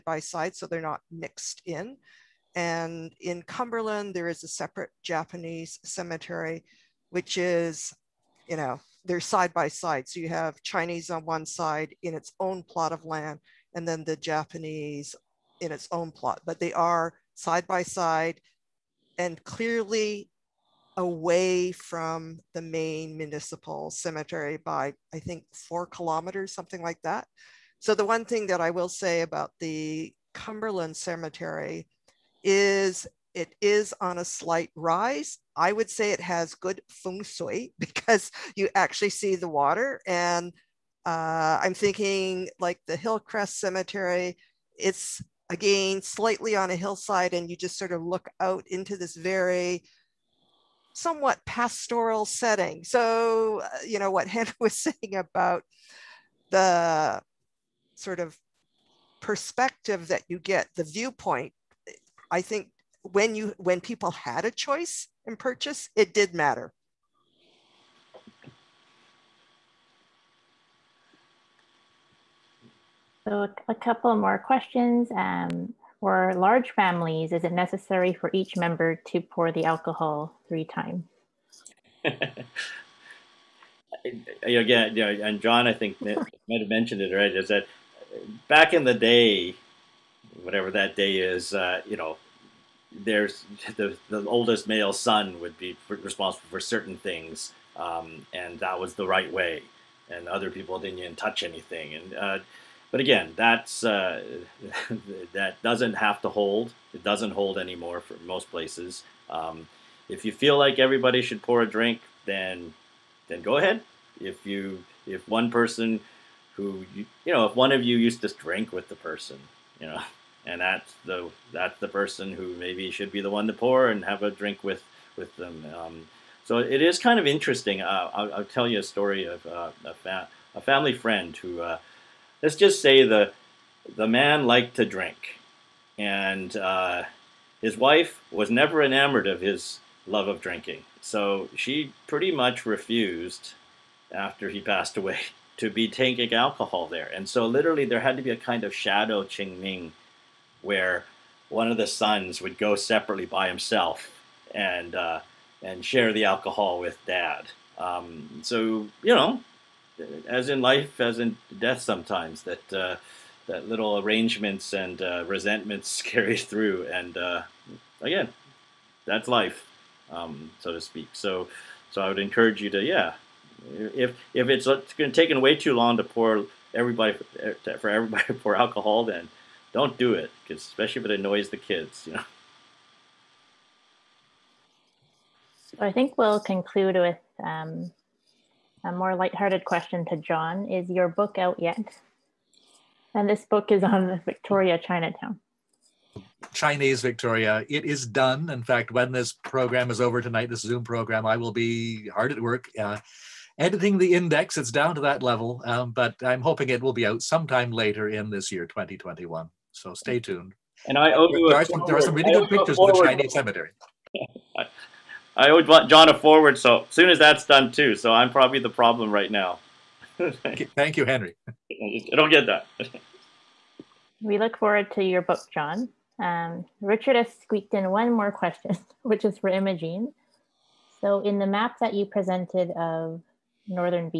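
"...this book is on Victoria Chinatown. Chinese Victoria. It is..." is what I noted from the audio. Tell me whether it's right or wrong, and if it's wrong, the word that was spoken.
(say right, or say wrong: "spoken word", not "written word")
right.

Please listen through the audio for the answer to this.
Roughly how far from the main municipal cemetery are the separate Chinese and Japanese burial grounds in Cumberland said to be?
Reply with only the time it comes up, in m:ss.
0:25.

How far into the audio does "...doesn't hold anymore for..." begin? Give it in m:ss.
1:47.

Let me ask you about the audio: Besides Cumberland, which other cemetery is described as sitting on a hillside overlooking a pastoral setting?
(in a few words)
Hillcrest Cemetery.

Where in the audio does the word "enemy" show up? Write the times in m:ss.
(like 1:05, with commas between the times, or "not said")
not said.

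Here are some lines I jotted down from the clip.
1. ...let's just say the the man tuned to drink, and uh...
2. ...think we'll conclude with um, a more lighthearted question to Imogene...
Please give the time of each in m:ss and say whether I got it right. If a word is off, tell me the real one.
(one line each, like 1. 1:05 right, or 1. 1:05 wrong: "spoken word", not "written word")
1. 2:12 wrong: "liked", not "tuned"
2. 3:05 wrong: "John", not "Imogene".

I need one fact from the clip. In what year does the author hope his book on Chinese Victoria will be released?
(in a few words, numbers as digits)
2021.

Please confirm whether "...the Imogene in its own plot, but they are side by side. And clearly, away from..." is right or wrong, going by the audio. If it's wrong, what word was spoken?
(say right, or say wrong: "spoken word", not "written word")
wrong: "Japanese", not "Imogene".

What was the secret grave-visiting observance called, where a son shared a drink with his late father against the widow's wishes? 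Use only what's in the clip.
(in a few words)
shadow Qingming.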